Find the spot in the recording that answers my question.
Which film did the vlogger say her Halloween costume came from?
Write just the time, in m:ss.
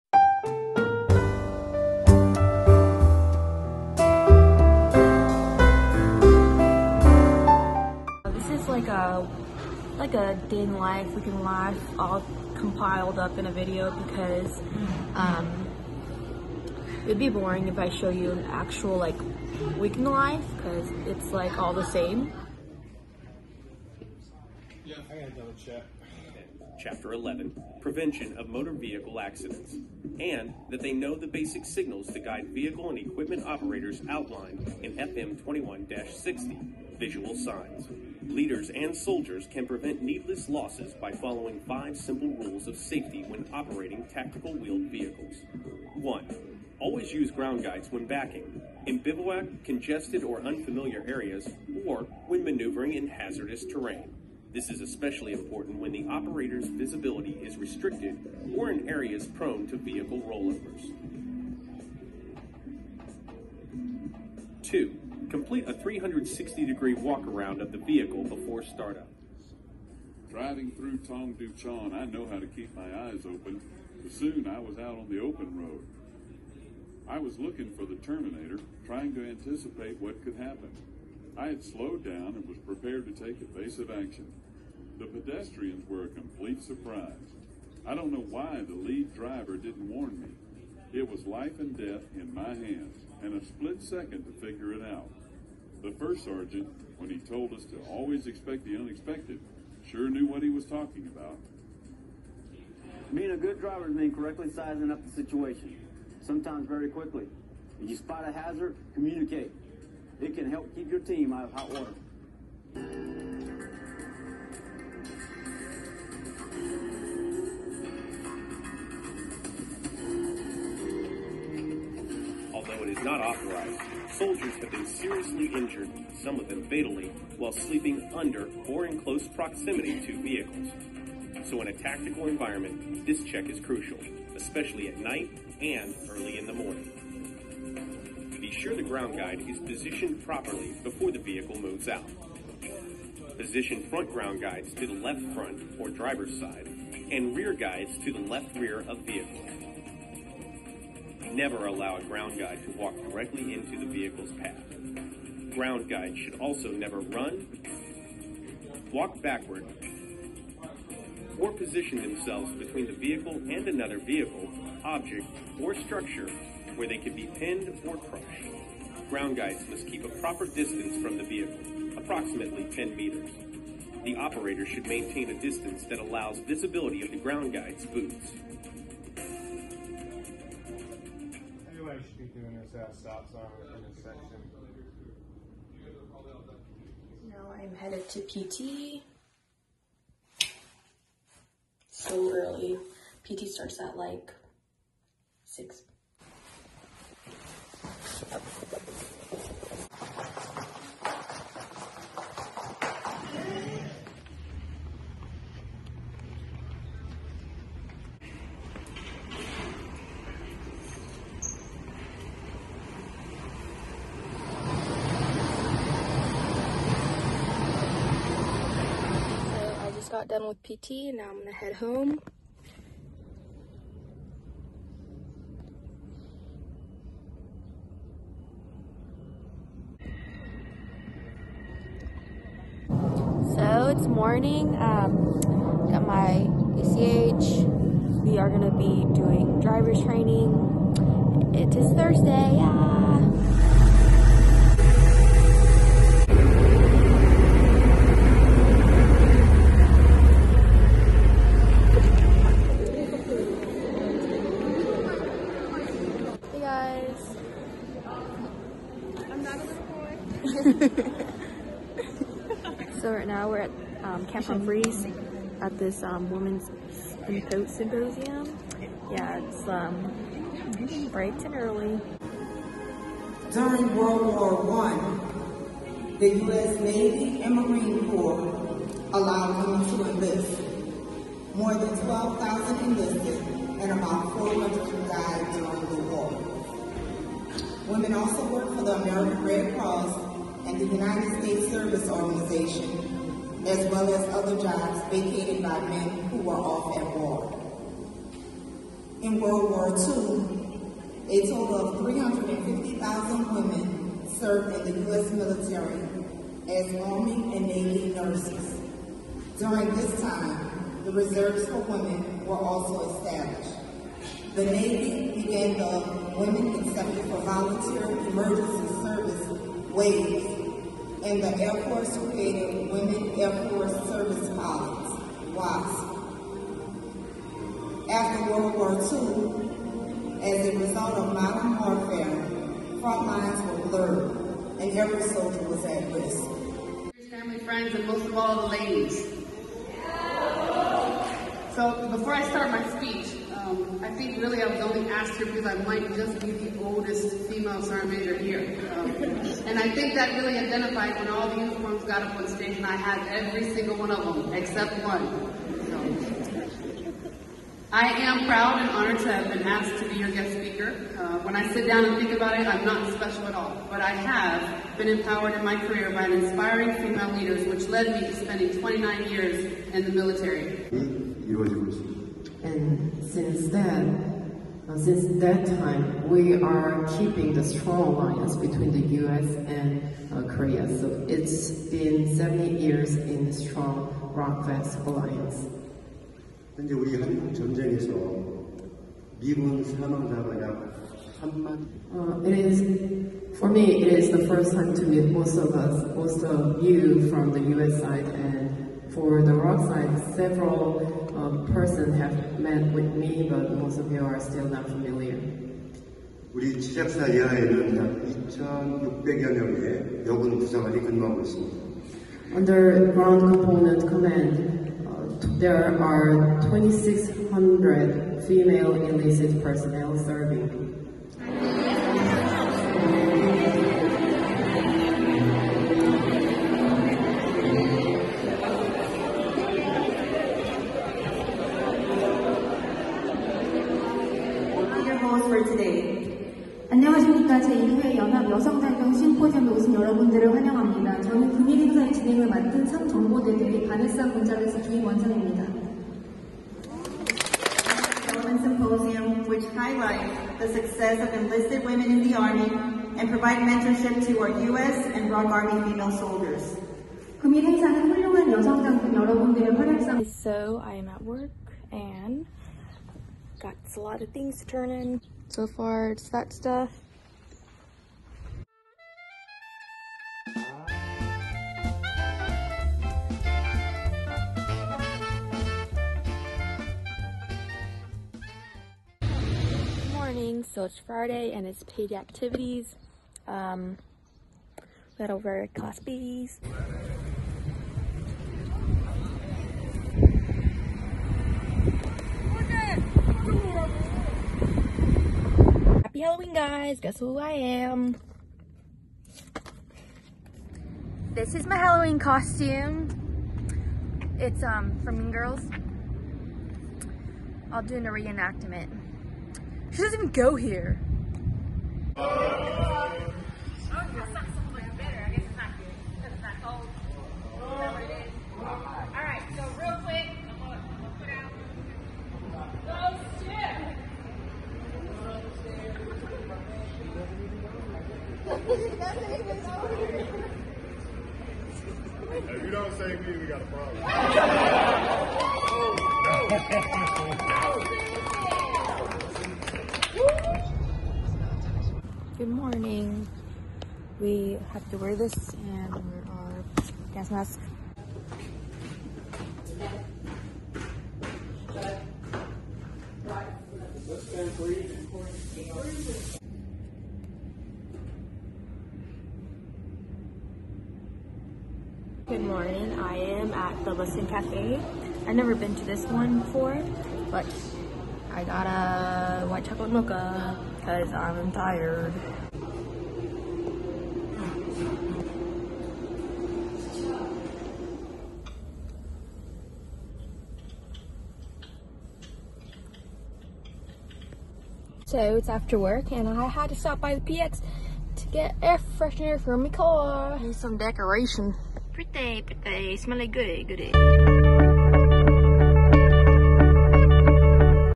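8:25.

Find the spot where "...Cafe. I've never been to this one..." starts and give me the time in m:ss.
9:24.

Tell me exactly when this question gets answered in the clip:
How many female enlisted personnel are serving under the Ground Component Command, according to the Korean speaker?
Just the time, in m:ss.
6:56.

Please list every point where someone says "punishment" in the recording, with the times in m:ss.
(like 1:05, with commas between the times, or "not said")
not said.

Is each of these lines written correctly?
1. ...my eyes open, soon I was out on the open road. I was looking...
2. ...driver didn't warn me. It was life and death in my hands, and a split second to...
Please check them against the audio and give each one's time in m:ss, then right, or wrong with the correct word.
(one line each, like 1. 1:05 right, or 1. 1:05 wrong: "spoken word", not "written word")
1. 1:12 right
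2. 1:29 right.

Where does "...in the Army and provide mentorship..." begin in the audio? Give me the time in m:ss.
7:32.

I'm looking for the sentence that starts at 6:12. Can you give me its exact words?
And since then, uh, since that time, we are keeping the strong alliance between the U.S.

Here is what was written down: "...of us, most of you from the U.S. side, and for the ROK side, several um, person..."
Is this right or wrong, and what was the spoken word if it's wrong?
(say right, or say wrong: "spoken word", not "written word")
right.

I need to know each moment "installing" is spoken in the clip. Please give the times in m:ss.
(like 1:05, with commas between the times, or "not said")
not said.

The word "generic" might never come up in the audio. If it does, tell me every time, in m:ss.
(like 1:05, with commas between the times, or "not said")
not said.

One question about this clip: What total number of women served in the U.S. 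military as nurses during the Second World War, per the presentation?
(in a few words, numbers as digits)
350,000.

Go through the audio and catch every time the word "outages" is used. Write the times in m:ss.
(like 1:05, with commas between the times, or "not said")
not said.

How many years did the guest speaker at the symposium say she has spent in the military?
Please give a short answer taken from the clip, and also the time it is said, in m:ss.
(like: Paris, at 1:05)
29 years, at 6:08.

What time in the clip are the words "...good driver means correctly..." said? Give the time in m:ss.
1:43.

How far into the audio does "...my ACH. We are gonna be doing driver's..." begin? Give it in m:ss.
3:56.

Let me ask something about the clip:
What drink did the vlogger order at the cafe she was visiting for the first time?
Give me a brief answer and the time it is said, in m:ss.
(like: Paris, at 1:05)
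White chocolate mocha, at 9:29.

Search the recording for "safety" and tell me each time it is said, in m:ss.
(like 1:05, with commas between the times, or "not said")
0:42.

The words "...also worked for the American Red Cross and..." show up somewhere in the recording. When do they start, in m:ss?
4:48.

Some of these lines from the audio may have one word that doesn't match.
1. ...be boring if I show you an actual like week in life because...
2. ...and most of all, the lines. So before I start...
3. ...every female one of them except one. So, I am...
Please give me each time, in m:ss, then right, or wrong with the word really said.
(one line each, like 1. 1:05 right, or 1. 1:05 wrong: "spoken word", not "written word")
1. 0:17 right
2. 5:37 wrong: "ladies", not "lines"
3. 5:53 wrong: "single", not "female".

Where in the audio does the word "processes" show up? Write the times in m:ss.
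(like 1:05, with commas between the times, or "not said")
not said.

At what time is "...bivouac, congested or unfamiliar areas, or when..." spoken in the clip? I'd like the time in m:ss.
0:48.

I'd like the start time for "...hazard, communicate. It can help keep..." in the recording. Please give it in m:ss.
1:48.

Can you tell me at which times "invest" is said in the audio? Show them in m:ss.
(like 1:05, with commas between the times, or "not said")
not said.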